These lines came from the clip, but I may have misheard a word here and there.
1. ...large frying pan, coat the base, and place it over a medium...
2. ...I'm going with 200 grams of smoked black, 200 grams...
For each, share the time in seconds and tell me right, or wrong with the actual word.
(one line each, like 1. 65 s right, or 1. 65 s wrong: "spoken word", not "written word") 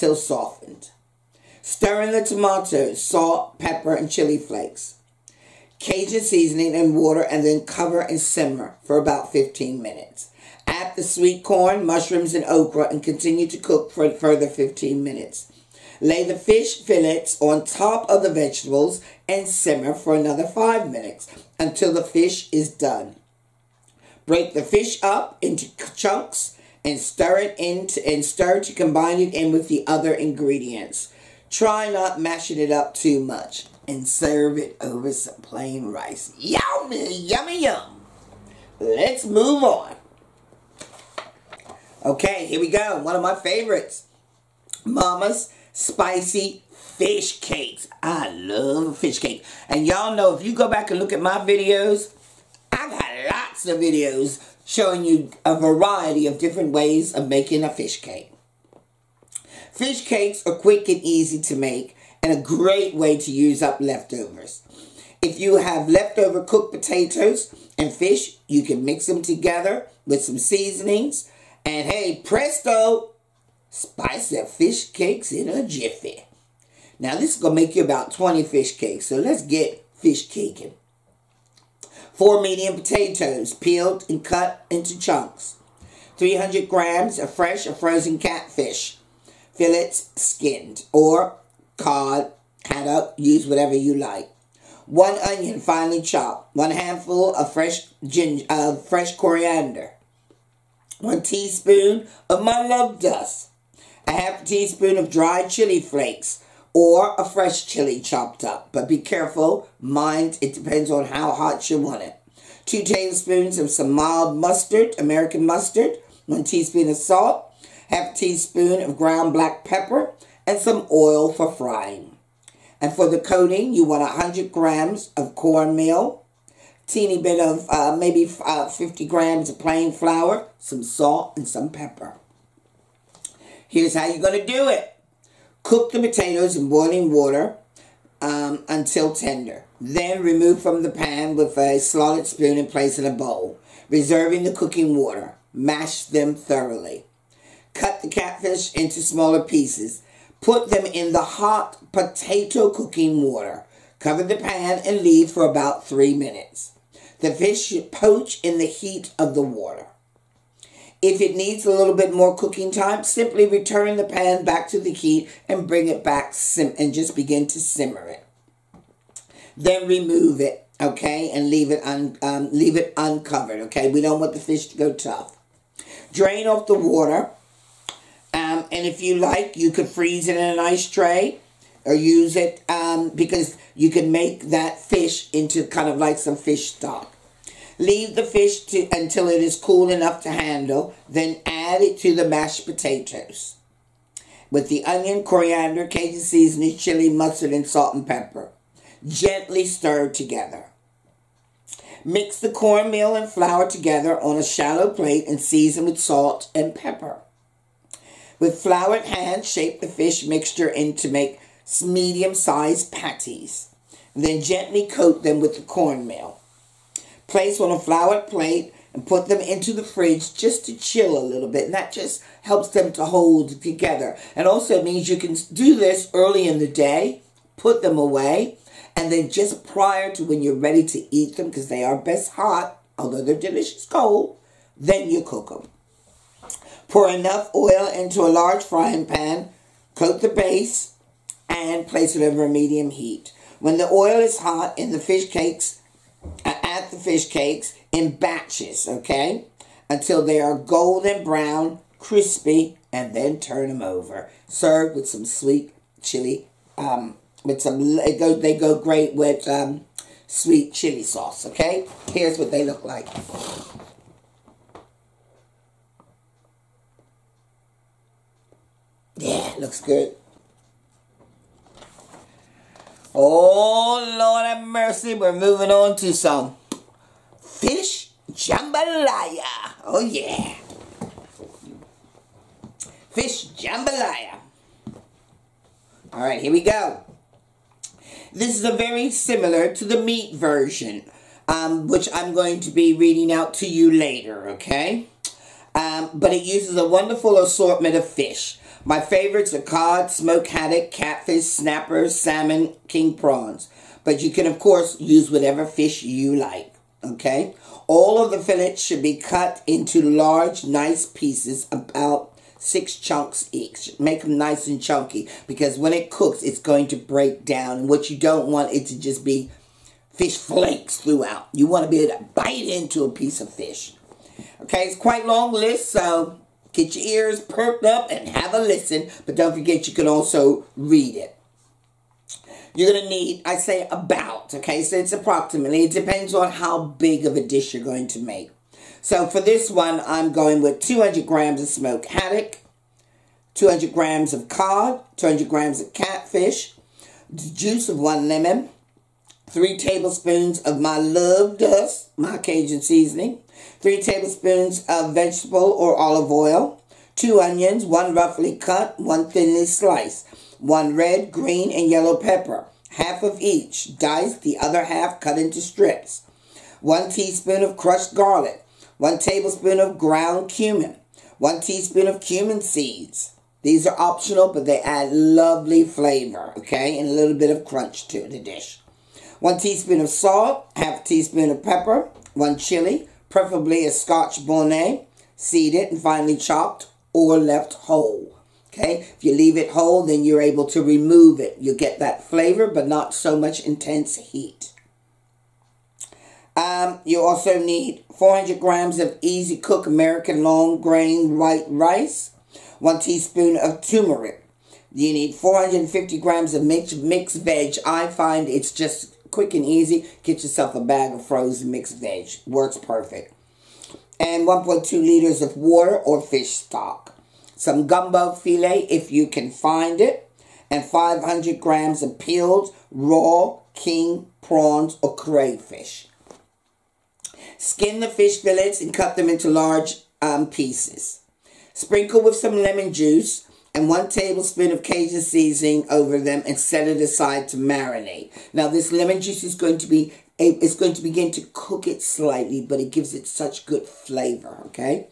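1. 238 s right
2. 340 s wrong: "haddock", not "black".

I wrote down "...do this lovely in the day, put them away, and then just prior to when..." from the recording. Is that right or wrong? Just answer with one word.
wrong.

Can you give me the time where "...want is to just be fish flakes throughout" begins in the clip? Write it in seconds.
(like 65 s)
318 s.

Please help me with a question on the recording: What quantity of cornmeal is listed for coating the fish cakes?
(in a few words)
100 grams.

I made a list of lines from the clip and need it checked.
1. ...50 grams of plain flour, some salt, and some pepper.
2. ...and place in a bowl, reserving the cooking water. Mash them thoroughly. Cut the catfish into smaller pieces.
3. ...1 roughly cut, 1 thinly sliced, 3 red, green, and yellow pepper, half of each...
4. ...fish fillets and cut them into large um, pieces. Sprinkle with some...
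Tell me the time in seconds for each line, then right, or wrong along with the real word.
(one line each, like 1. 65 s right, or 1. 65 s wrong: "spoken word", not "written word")
1. 128 s right
2. 142 s right
3. 357 s wrong: "1", not "3"
4. 428 s right.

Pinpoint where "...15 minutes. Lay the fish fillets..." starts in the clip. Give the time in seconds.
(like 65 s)
14 s.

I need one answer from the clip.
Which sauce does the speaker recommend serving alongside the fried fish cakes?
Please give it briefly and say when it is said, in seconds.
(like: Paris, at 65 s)
Sweet chili sauce, at 260 s.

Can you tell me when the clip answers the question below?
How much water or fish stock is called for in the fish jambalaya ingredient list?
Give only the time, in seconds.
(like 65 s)
414 s.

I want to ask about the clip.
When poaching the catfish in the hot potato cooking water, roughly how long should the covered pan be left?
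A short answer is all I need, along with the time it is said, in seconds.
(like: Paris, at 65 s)
3 minutes, at 155 s.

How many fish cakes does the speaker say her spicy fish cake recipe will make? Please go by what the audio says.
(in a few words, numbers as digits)
20.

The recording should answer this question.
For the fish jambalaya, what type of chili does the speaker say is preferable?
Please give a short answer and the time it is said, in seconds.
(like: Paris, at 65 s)
Scotch bonnet, at 383 s.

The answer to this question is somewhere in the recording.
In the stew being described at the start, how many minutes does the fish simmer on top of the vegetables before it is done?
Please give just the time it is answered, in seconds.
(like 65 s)
20 s.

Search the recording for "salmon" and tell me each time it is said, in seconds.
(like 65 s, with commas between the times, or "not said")
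302 s.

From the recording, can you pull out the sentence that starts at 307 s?
All of the fillets should be cut into large, nice pieces, about six chunks each.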